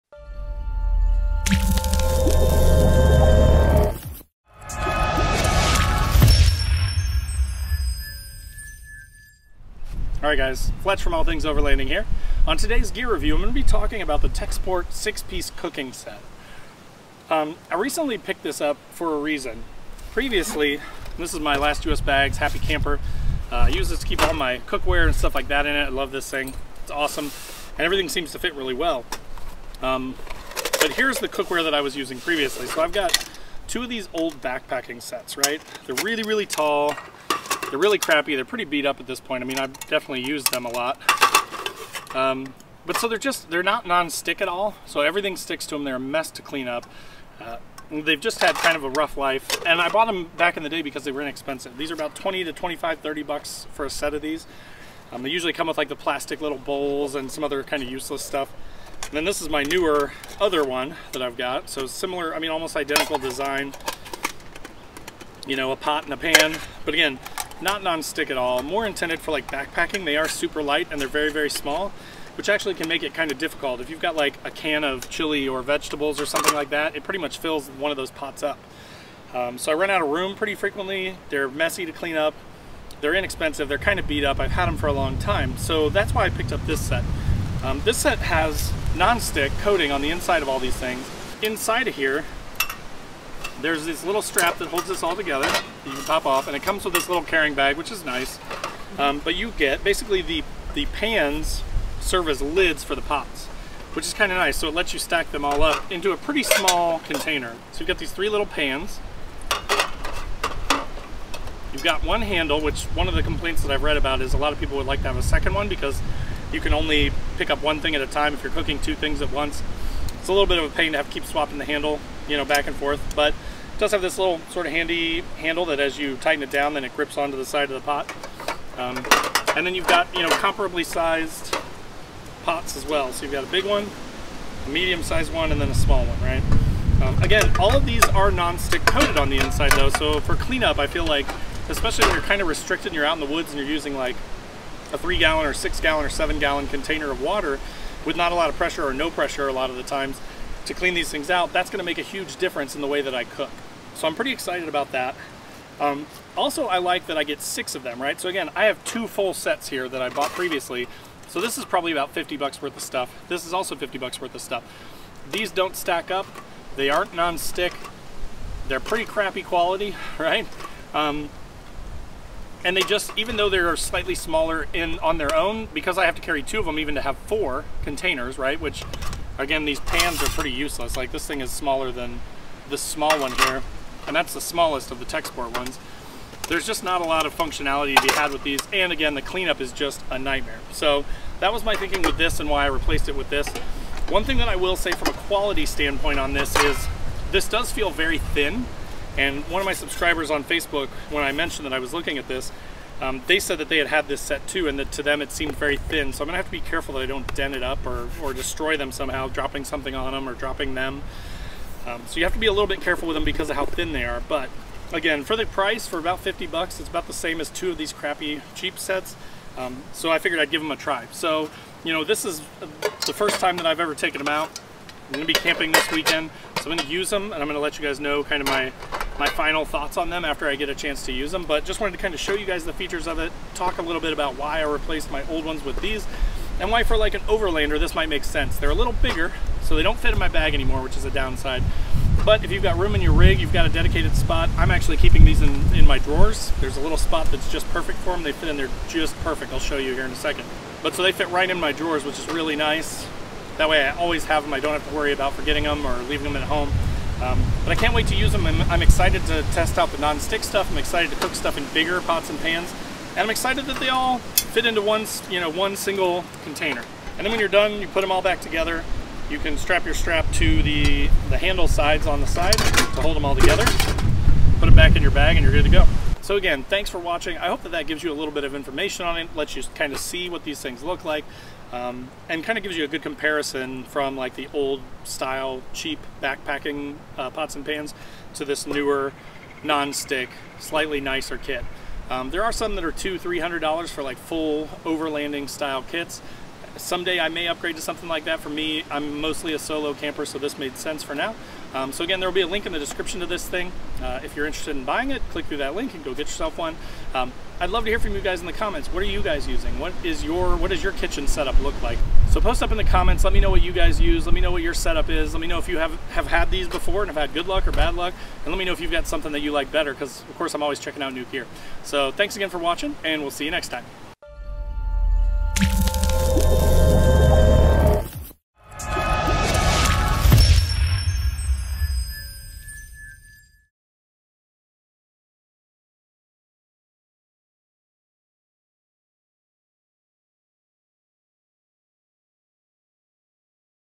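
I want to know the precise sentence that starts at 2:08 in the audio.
Um, and then you've got, you know, comparably sized pots as well.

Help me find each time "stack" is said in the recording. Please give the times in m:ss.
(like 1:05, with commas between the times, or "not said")
1:44, 2:45.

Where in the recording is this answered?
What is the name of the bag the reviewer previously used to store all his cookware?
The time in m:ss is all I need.
0:22.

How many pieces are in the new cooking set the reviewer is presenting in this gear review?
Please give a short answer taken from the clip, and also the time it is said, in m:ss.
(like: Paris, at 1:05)
6, at 0:14.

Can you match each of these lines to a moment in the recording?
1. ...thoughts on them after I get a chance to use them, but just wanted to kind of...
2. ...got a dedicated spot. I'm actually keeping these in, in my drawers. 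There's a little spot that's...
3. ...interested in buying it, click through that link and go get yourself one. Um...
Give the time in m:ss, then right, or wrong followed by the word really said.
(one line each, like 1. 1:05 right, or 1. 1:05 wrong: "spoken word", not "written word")
1. 3:49 right
2. 4:03 right
3. 5:04 right.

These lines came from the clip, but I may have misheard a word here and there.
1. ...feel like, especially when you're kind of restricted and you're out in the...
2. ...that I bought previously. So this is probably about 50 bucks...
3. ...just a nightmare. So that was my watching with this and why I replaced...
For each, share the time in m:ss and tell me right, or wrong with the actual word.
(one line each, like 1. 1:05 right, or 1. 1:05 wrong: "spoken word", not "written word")
1. 2:20 right
2. 2:39 right
3. 3:09 wrong: "thinking", not "watching".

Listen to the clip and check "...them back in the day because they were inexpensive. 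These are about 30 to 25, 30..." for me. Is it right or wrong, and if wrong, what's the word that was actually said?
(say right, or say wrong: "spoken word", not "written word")
wrong: "20", not "30".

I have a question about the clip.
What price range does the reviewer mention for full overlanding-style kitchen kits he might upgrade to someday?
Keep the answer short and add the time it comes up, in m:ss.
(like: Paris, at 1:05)
$200 to $300, at 4:52.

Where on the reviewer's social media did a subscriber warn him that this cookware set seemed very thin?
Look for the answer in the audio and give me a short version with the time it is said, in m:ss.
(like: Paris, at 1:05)
Facebook, at 3:20.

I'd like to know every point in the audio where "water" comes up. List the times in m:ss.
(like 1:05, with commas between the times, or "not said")
2:27.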